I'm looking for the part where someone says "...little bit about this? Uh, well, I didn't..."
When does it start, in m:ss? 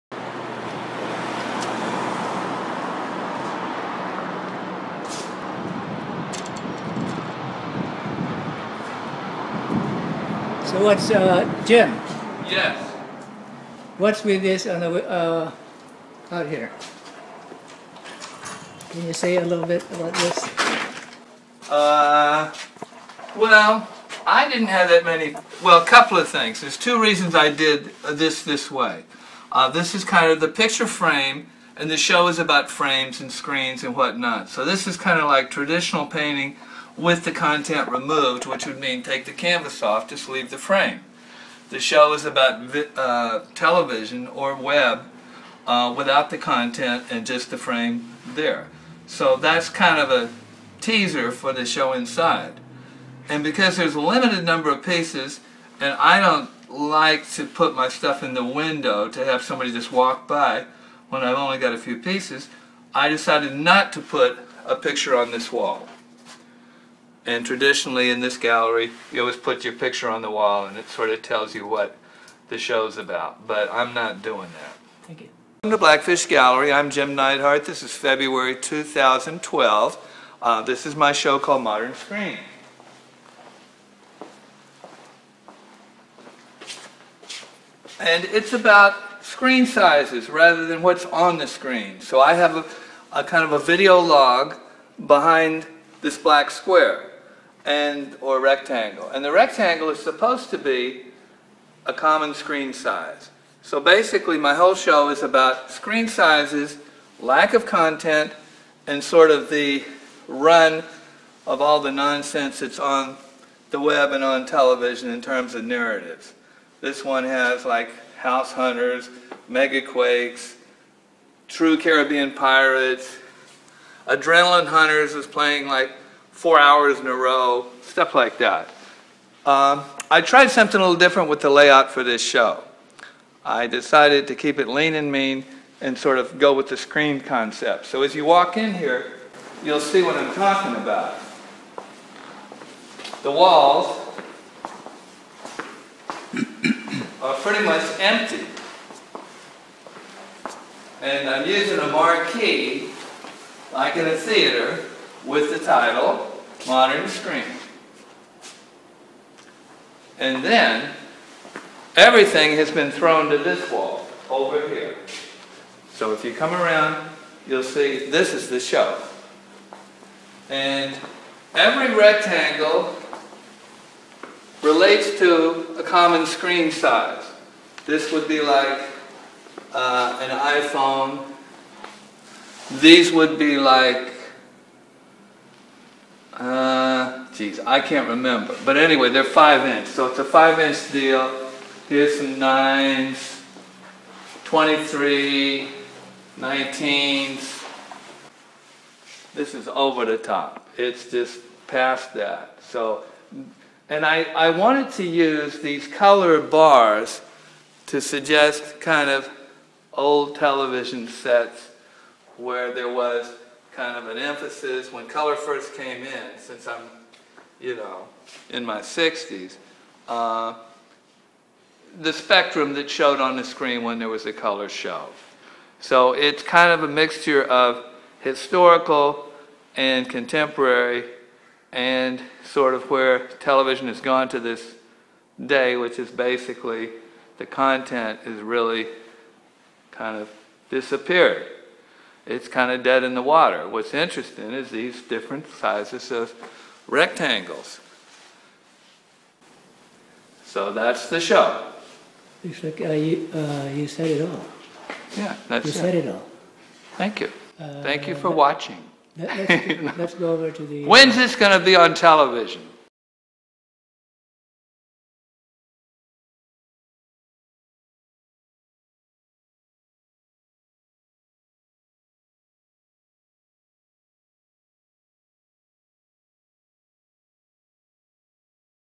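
0:19.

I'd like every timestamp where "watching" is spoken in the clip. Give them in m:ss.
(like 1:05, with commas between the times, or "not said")
4:18.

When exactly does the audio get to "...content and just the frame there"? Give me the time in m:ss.
0:46.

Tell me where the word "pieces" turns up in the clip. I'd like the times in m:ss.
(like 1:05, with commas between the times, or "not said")
0:54, 1:01.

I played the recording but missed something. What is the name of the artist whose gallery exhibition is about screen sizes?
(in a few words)
Jim Neidhardt.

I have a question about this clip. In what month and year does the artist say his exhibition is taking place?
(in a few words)
February 2012.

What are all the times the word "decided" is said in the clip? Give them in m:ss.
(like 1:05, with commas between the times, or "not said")
1:03, 2:13.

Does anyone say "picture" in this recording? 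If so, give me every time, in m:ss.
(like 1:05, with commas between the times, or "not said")
0:30, 1:04, 1:09.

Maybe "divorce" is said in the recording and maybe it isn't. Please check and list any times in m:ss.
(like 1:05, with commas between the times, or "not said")
not said.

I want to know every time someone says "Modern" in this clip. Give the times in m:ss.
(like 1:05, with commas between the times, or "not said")
1:21, 2:36.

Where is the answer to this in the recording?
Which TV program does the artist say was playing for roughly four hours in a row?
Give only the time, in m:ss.
2:04.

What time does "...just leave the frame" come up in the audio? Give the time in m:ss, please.
0:40.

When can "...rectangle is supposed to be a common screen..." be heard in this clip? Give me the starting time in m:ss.
1:39.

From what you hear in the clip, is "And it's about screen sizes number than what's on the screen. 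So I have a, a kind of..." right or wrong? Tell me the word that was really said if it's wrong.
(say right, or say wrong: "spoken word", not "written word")
wrong: "rather", not "number".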